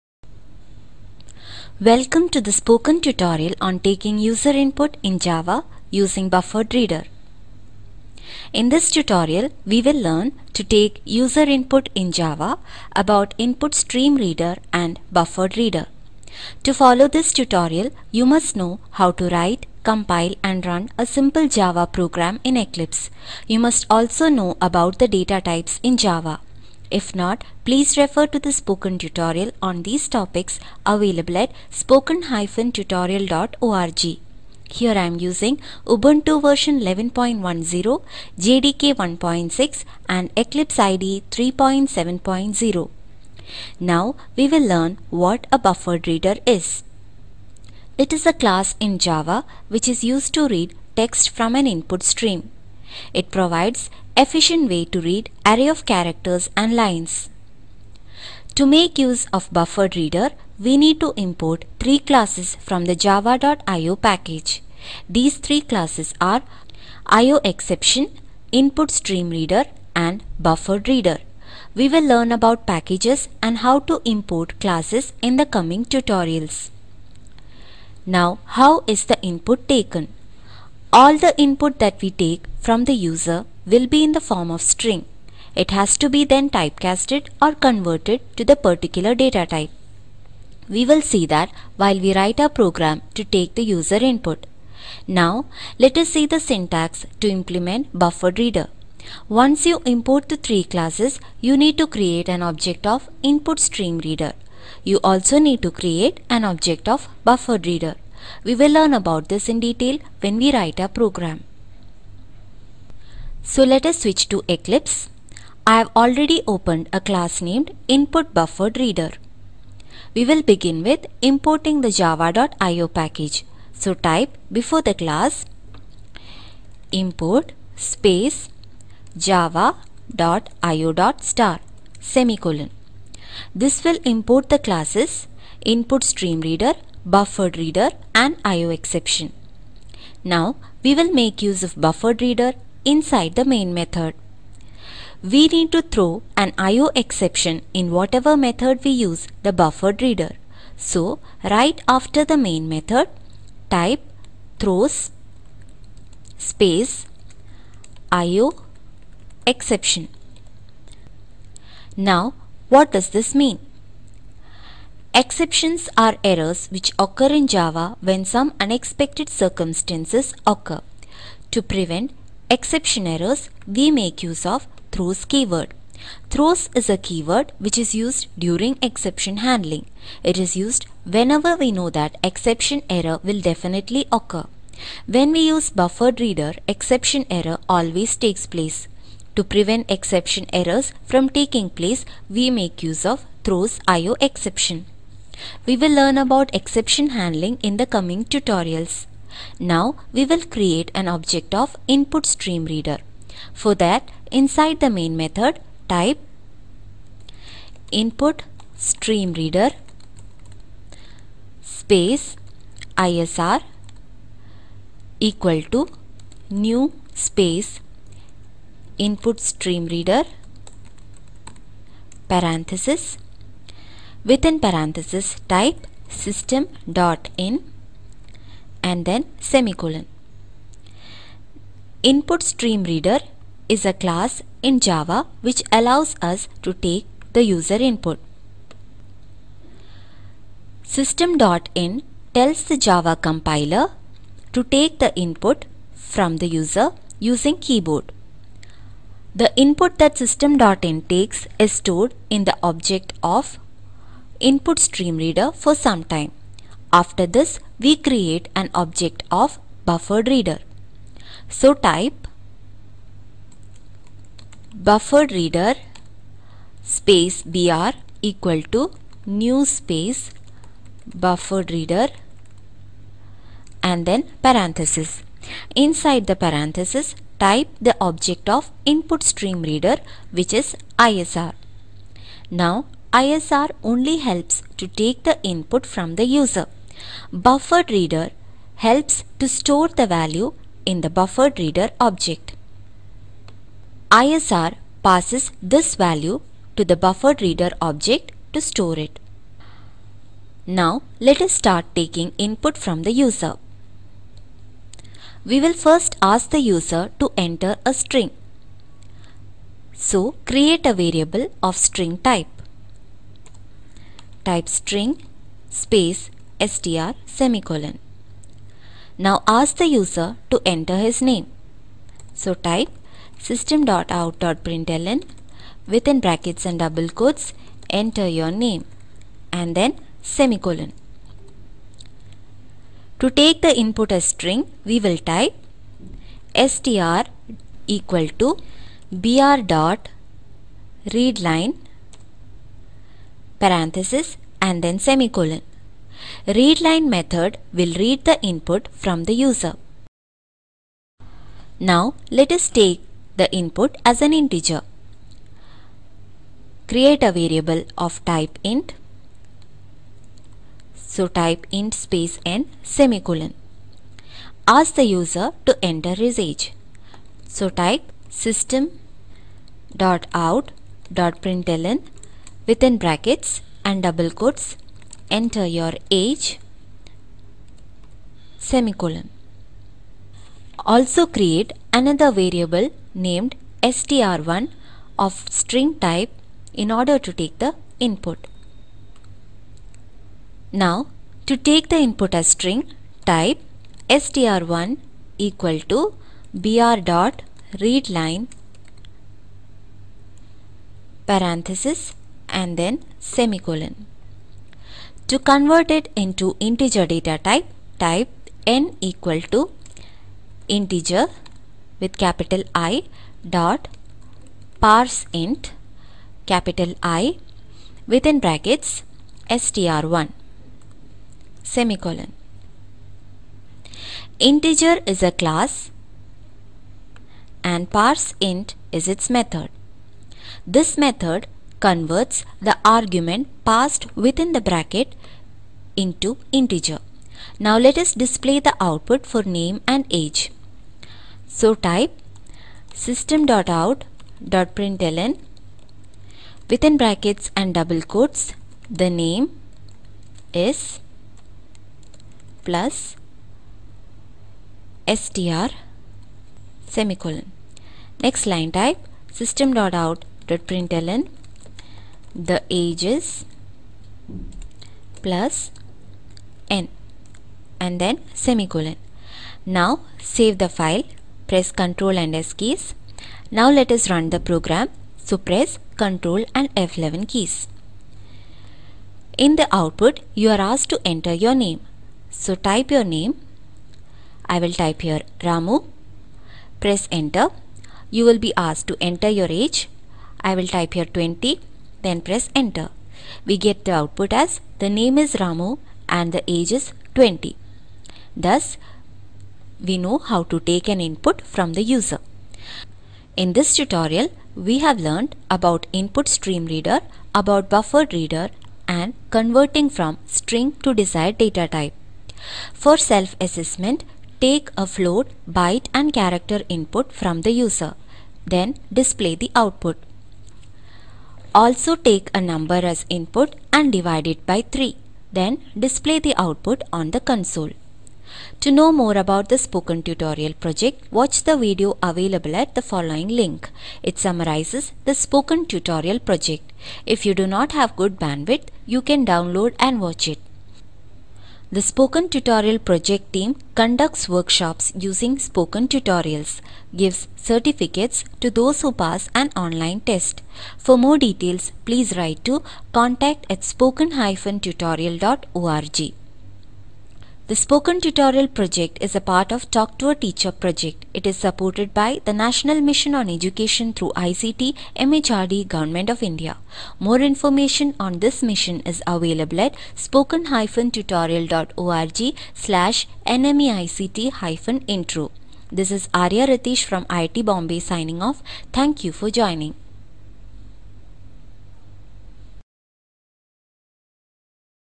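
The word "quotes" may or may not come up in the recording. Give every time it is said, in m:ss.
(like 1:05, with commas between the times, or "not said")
5:27, 6:14, 7:28.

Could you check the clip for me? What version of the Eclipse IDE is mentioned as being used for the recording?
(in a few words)
3.7.0.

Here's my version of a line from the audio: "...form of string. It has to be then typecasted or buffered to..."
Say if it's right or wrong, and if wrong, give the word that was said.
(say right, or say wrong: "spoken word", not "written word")
wrong: "converted", not "buffered".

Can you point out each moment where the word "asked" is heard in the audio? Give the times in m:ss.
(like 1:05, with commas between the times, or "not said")
8:00, 8:08.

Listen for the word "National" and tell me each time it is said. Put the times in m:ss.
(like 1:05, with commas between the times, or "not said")
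9:22.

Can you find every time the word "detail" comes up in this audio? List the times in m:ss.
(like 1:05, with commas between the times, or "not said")
1:49, 9:11.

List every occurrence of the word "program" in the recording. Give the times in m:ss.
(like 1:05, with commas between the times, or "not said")
0:21, 1:32, 1:51, 7:54.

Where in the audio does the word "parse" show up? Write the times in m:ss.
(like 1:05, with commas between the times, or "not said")
6:54, 7:07.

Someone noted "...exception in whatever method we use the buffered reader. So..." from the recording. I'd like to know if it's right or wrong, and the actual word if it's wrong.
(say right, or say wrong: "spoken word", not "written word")
right.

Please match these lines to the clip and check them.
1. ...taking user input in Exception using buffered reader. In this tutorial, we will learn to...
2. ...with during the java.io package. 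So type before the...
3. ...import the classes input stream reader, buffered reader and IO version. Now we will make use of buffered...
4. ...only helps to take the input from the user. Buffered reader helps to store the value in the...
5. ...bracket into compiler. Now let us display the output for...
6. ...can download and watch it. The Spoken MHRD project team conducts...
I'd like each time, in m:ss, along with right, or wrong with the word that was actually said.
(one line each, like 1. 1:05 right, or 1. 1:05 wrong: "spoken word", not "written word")
1. 0:03 wrong: "Java", not "Exception"
2. 2:00 wrong: "importing", not "during"
3. 2:14 wrong: "exception", not "version"
4. 4:43 right
5. 7:14 wrong: "integer", not "compiler"
6. 8:59 wrong: "Tutorial", not "MHRD".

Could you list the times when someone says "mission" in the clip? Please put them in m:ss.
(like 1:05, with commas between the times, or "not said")
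9:22, 9:28.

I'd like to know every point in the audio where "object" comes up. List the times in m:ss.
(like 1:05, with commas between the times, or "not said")
1:42, 1:46, 3:21, 4:12, 4:18, 4:38, 4:51, 4:57.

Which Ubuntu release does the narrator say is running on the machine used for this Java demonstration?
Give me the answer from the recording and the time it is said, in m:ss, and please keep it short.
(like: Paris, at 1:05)
11.10, at 0:36.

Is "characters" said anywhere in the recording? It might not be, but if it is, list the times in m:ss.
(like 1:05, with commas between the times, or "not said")
0:55, 8:36.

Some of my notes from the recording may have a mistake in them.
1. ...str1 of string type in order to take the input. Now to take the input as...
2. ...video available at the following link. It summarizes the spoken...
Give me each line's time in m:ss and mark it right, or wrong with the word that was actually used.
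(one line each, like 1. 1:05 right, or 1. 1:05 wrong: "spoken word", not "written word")
1. 6:23 right
2. 8:51 right.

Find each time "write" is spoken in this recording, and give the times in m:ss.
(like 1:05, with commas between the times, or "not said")
0:19, 1:32, 1:50, 9:12.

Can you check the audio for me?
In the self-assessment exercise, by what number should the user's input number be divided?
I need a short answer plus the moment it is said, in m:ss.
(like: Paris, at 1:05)
3, at 8:44.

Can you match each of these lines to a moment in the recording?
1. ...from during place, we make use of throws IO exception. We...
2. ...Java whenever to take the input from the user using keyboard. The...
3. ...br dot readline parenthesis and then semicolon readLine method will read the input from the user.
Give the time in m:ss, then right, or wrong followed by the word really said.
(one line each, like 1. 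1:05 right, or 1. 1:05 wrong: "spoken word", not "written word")
1. 3:11 wrong: "taking", not "during"
2. 4:02 wrong: "compiler", not "whenever"
3. 5:39 right.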